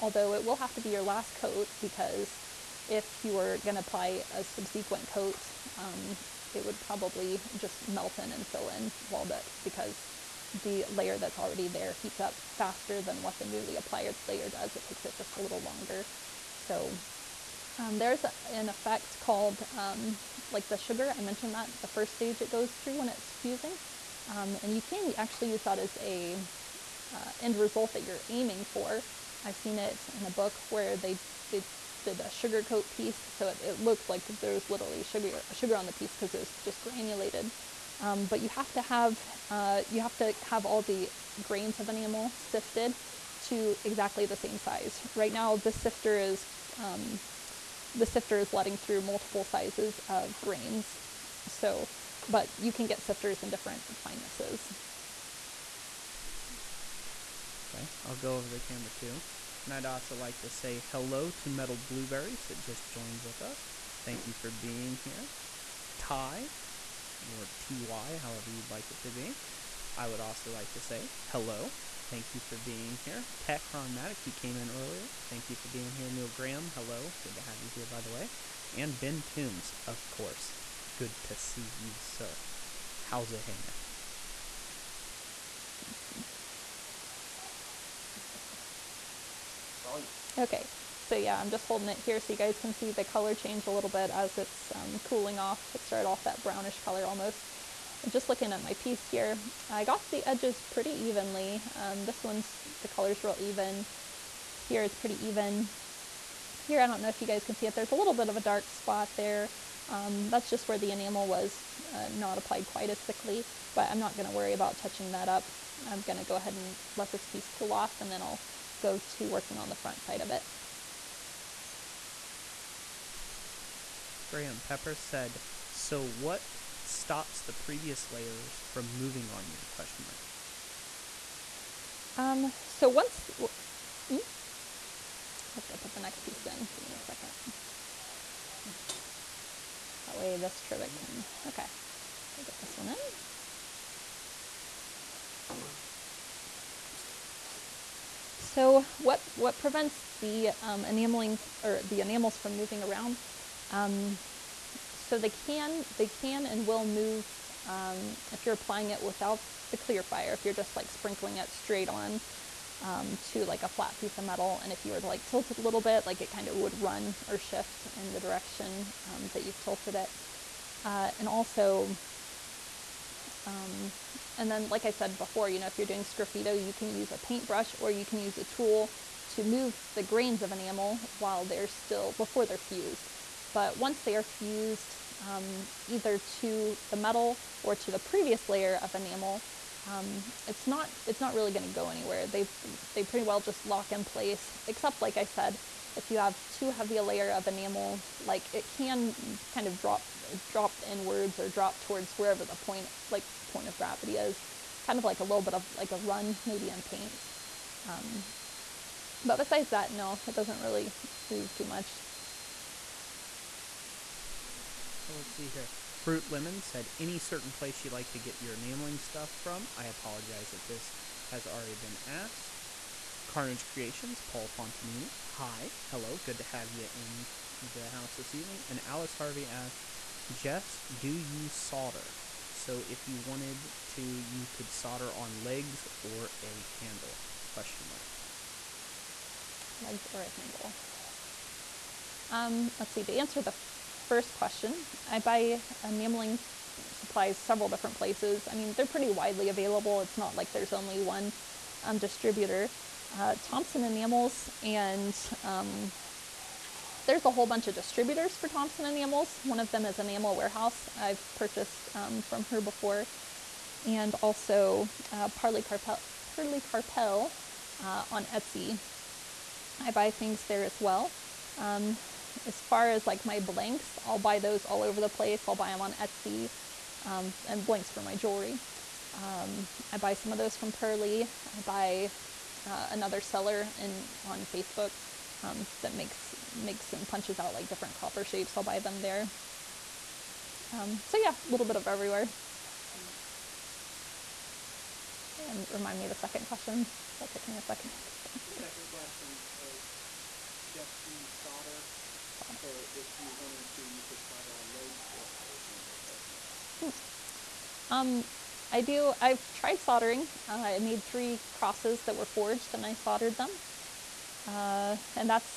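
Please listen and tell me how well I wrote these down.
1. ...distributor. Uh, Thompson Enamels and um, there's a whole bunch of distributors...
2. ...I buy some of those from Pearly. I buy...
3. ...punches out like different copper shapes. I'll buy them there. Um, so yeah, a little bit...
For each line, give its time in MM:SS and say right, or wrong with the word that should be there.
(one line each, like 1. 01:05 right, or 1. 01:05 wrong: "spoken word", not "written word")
1. 04:11 right
2. 04:39 right
3. 04:47 right.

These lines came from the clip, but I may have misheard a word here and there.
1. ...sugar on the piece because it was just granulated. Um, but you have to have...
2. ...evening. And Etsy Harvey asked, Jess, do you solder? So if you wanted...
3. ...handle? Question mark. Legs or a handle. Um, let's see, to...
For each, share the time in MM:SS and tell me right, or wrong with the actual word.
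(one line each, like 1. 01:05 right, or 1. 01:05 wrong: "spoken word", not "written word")
1. 00:35 right
2. 03:48 wrong: "Alice", not "Etsy"
3. 03:56 right.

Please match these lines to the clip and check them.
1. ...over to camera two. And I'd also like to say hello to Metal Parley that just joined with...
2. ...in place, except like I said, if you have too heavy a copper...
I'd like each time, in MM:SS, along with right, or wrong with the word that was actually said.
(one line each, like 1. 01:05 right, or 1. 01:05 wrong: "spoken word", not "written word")
1. 00:58 wrong: "Blueberries", not "Parley"
2. 03:13 wrong: "layer", not "copper".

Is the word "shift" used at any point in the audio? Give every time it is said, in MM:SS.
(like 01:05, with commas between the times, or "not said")
02:47.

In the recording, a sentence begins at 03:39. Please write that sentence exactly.
I apologize if this has already been asked.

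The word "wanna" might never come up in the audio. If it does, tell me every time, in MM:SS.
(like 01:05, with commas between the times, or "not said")
not said.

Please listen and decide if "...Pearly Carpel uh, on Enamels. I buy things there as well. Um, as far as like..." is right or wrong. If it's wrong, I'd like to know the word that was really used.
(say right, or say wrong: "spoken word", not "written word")
wrong: "Etsy", not "Enamels".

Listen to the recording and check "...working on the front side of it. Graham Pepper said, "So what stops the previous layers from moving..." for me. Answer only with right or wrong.
right.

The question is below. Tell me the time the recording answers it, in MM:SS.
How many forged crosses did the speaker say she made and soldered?
05:11.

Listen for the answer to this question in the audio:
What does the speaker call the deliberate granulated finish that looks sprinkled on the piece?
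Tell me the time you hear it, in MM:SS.
00:32.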